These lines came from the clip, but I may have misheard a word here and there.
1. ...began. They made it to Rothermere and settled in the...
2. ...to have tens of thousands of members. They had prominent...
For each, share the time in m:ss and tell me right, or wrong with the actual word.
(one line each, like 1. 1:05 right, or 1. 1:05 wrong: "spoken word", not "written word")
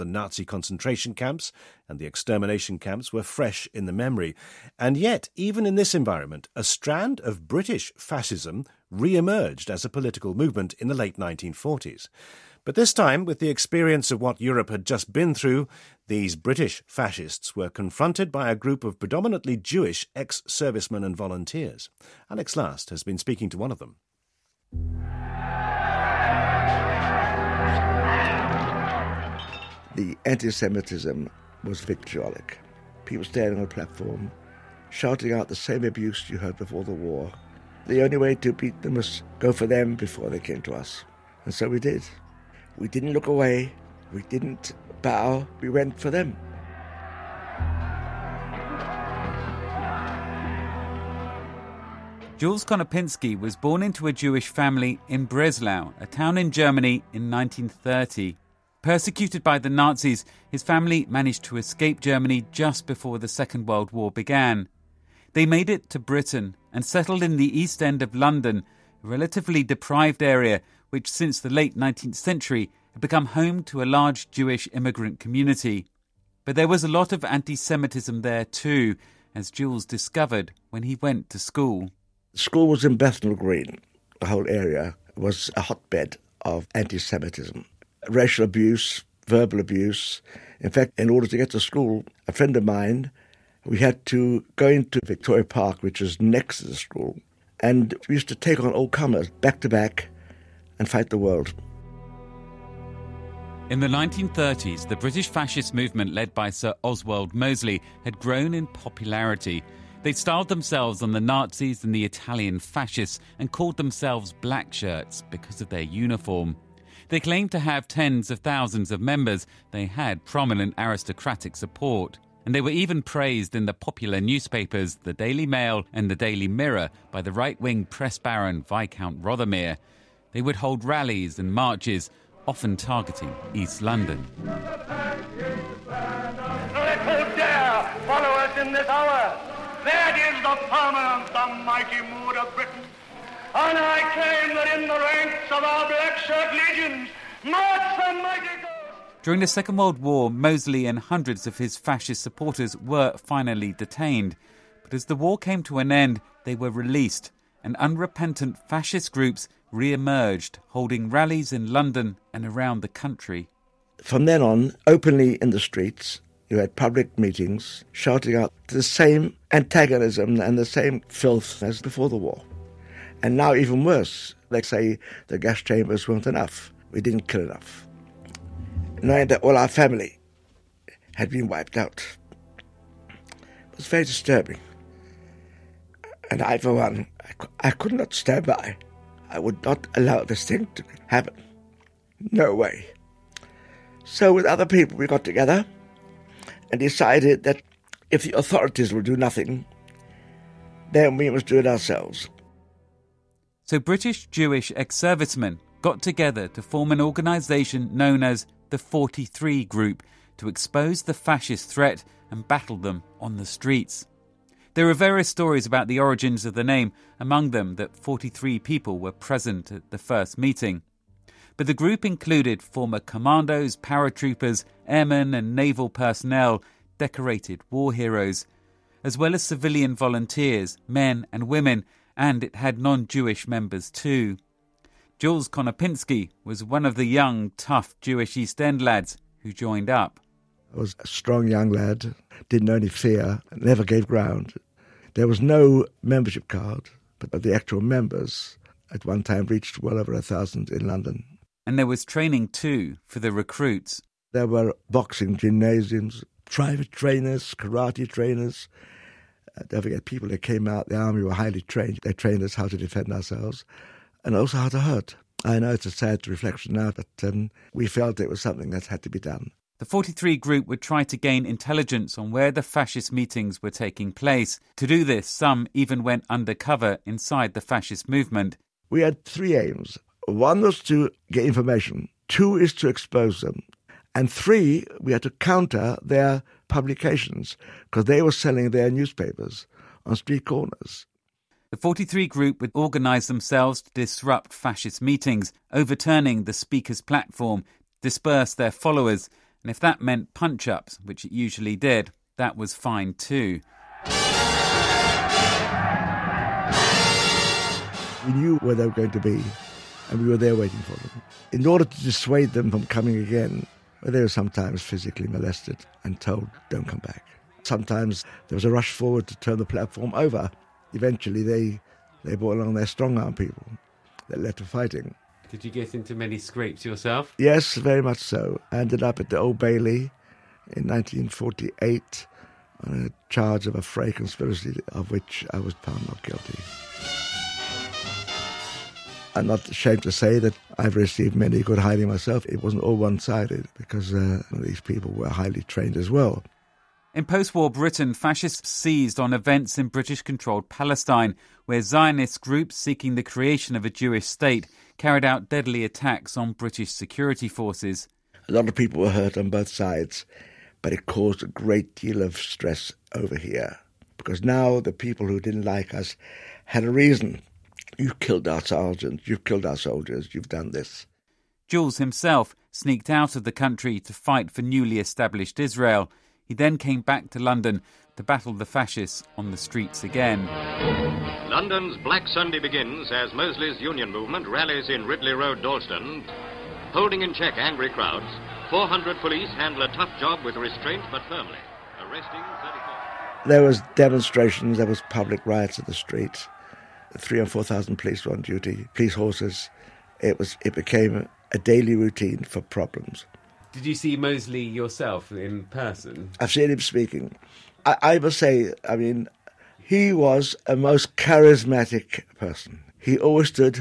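1. 1:04 wrong: "Britain", not "Rothermere"
2. 1:57 right.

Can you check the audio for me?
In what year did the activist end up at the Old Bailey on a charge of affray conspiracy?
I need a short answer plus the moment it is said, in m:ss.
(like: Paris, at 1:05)
1948, at 5:30.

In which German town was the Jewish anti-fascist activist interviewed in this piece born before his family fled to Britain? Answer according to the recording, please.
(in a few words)
Breslau.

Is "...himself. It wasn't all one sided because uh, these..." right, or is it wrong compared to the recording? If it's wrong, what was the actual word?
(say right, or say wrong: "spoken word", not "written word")
wrong: "myself", not "himself".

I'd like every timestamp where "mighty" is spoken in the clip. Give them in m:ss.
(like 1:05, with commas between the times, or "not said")
2:21, 2:28.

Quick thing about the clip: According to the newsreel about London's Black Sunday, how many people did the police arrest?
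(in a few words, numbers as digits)
34.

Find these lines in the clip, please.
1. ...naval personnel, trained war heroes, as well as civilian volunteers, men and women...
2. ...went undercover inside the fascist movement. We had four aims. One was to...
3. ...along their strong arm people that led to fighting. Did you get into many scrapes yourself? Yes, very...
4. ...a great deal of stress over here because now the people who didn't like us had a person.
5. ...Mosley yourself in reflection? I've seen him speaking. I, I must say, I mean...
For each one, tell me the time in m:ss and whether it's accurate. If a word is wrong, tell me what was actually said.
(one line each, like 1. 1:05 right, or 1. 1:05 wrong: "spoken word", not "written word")
1. 3:45 wrong: "decorated", not "trained"
2. 4:36 wrong: "three", not "four"
3. 5:22 right
4. 6:01 wrong: "reason", not "person"
5. 6:44 wrong: "person", not "reflection".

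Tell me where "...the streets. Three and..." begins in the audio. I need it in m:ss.
6:35.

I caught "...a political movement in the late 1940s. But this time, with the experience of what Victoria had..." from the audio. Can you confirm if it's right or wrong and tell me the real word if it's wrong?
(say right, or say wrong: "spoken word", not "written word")
wrong: "Europe", not "Victoria".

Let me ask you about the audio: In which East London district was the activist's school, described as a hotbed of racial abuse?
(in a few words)
Bethnal Green.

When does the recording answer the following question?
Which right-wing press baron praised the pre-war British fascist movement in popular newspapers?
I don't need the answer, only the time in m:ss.
2:08.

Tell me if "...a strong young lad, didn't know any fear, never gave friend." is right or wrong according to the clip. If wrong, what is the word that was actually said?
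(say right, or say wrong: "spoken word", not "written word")
wrong: "ground", not "friend".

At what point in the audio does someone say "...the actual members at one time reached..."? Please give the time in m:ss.
4:07.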